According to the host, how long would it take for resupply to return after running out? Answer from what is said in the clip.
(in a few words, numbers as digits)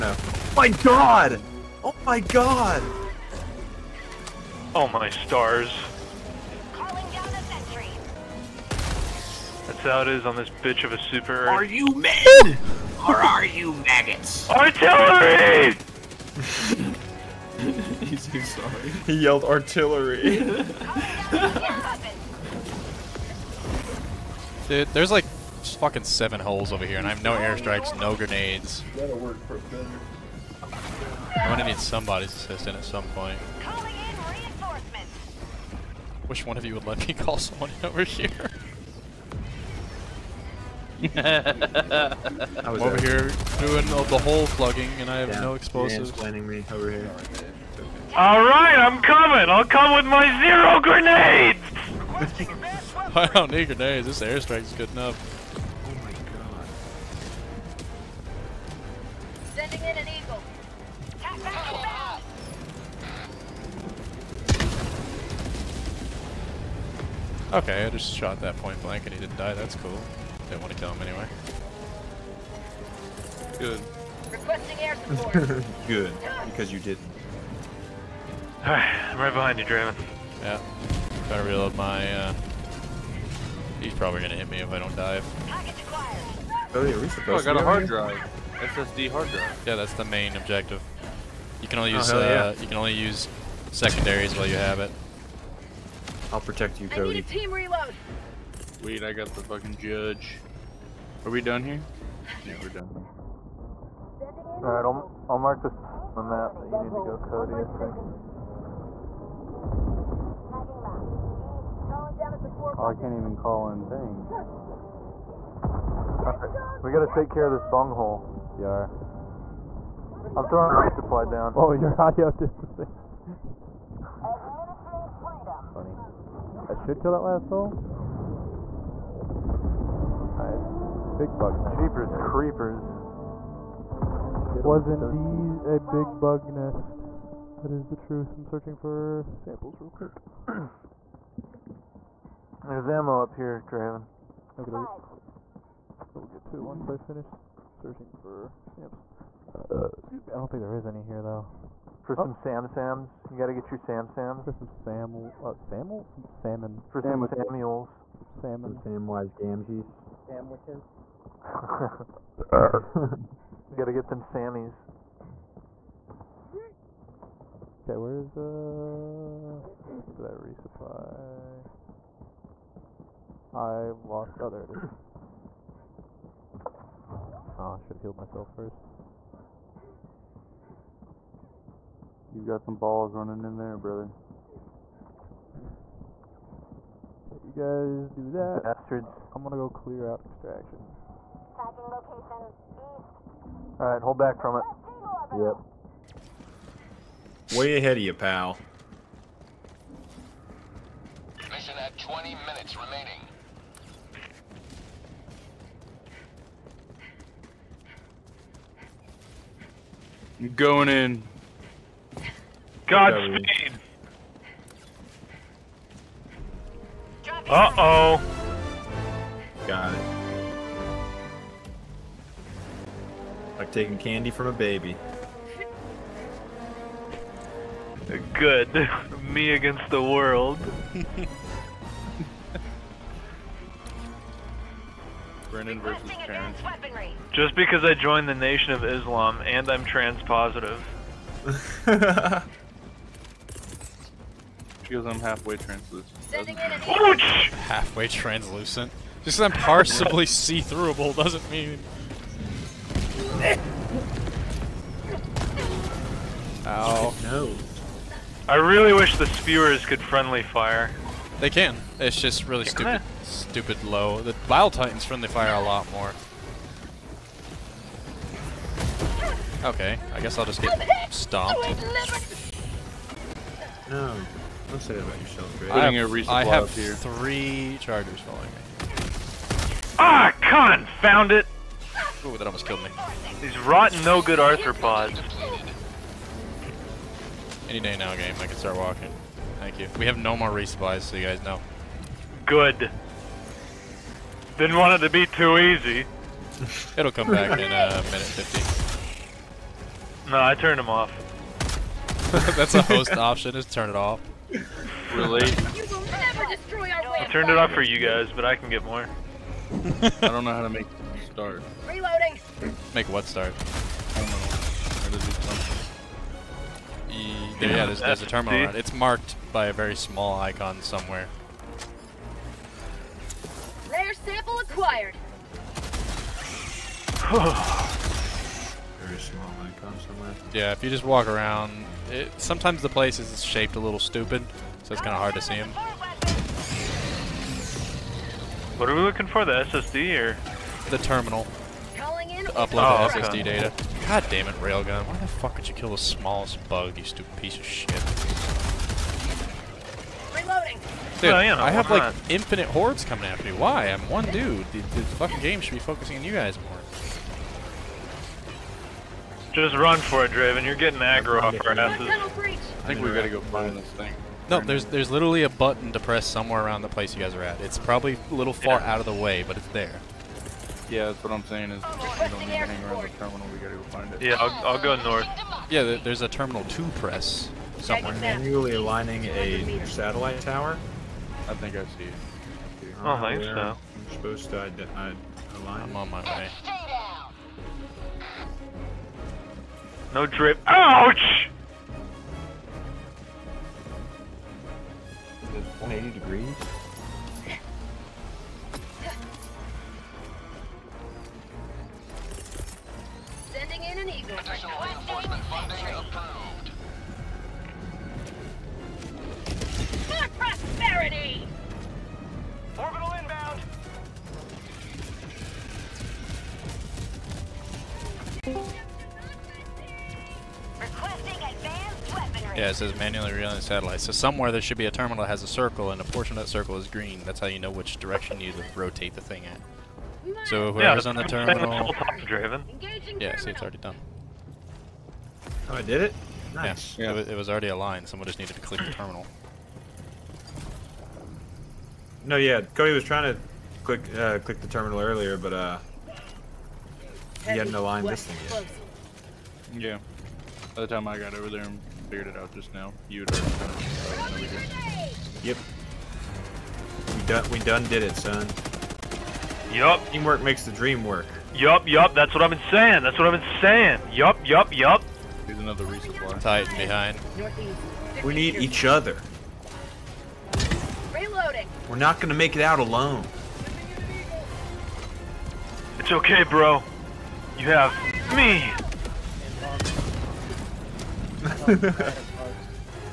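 a minute 50.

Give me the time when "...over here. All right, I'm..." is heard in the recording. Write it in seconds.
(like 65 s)
46 s.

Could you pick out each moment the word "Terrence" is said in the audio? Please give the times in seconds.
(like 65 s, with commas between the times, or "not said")
236 s.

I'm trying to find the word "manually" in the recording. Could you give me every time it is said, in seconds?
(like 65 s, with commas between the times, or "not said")
378 s, 422 s.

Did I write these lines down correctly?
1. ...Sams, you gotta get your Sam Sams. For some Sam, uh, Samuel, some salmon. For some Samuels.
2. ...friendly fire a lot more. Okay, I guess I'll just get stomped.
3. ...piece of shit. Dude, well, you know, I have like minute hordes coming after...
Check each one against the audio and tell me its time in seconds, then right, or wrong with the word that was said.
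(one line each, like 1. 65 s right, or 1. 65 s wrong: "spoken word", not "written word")
1. 152 s right
2. 265 s right
3. 347 s wrong: "infinite", not "minute".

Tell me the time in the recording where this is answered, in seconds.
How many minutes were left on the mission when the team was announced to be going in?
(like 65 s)
201 s.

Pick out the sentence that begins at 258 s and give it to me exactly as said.
I really wish the spewers could friendly fire.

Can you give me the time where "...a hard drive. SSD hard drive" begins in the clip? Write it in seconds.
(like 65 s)
87 s.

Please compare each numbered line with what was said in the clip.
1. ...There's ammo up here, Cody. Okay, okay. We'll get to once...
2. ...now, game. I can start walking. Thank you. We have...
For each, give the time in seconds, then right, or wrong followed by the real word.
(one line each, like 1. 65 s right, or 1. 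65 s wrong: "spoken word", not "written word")
1. 142 s wrong: "Draven", not "Cody"
2. 287 s right.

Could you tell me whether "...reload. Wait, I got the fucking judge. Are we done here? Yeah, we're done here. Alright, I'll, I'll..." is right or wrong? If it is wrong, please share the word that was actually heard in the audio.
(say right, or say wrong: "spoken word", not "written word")
right.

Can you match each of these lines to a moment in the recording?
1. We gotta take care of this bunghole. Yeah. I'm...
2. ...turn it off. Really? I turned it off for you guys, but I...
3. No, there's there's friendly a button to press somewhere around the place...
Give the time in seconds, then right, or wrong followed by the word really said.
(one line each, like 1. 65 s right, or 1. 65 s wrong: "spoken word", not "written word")
1. 116 s right
2. 303 s right
3. 364 s wrong: "literally", not "friendly".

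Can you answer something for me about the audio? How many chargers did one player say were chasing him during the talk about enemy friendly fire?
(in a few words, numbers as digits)
3.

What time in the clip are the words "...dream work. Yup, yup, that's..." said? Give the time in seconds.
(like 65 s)
460 s.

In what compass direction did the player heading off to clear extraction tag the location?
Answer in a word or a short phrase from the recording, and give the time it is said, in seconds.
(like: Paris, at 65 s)
East, at 192 s.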